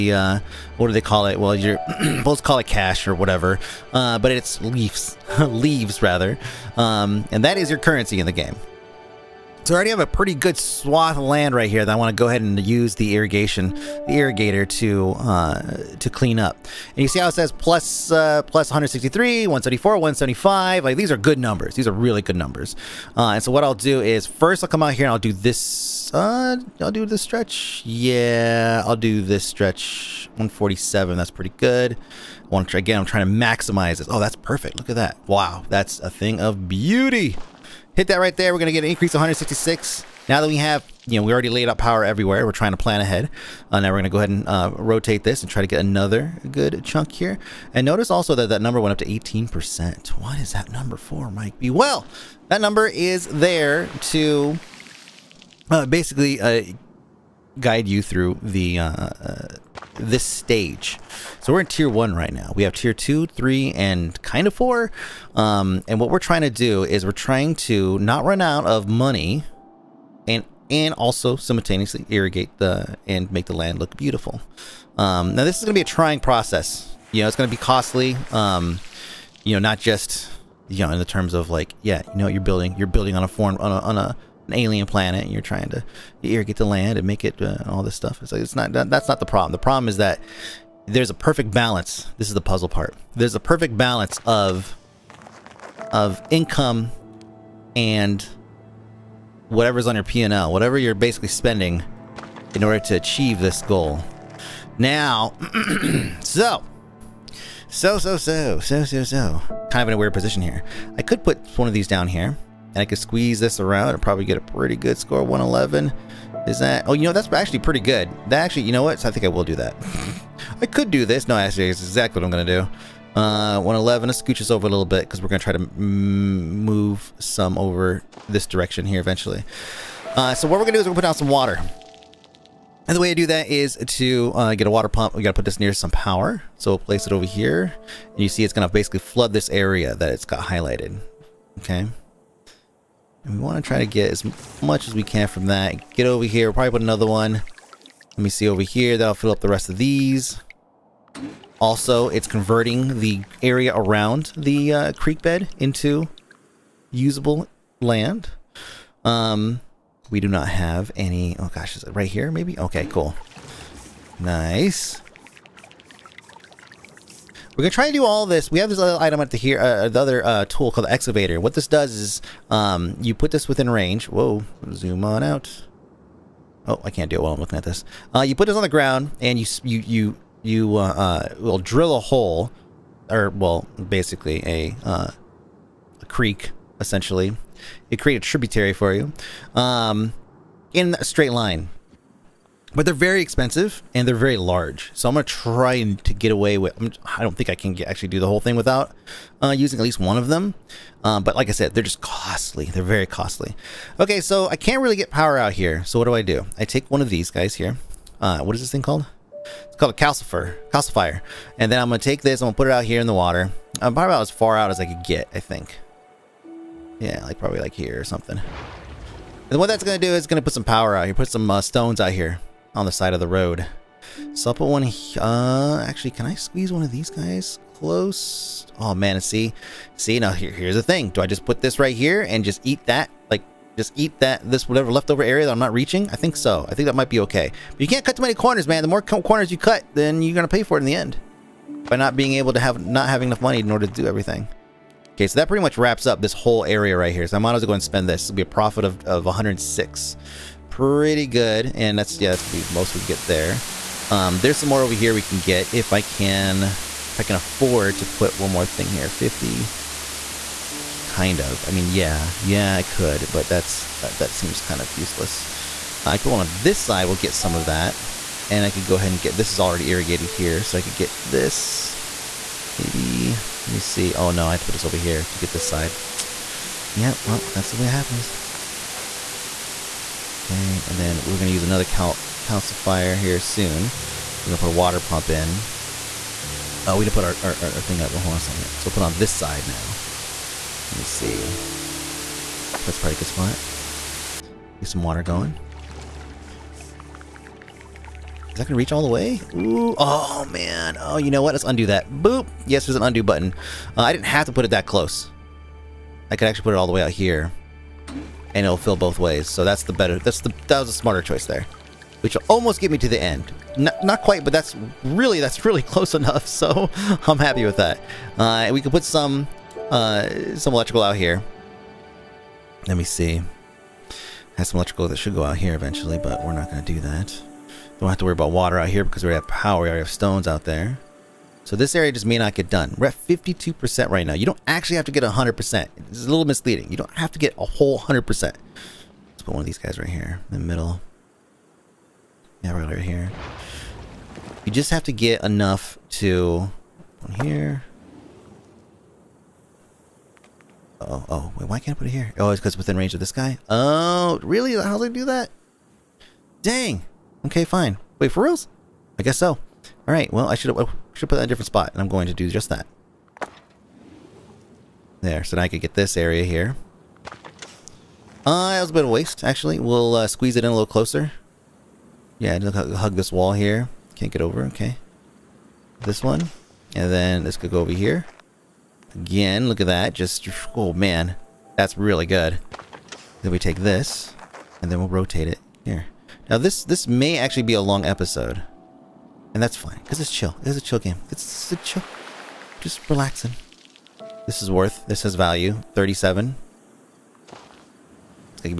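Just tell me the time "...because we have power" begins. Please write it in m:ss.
5:29.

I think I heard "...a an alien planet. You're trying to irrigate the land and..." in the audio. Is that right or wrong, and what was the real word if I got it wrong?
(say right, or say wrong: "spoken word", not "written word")
right.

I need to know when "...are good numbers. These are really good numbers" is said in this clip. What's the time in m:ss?
0:21.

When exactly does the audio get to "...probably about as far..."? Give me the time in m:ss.
3:33.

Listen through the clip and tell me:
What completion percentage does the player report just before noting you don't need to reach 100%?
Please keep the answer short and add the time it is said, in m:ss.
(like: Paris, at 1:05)
52%, at 5:33.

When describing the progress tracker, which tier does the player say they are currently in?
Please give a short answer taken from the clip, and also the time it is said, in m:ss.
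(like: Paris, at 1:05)
Tier one, at 1:01.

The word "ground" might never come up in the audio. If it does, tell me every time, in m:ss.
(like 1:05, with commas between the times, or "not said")
2:58.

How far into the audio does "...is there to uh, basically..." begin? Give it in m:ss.
0:52.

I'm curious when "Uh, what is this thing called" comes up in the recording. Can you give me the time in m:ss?
3:28.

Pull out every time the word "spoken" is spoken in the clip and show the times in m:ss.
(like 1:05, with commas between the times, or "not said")
not said.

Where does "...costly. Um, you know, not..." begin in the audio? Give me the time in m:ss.
1:17.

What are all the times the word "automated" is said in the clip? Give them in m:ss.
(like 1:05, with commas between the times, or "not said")
not said.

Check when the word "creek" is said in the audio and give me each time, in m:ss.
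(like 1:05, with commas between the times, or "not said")
2:34, 3:06.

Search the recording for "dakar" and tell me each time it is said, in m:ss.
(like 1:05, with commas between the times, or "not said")
not said.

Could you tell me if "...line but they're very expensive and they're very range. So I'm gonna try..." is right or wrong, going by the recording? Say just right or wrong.
wrong.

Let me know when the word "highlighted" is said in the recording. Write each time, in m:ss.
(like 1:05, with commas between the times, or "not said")
2:20.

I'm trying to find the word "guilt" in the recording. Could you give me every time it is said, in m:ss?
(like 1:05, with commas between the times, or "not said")
not said.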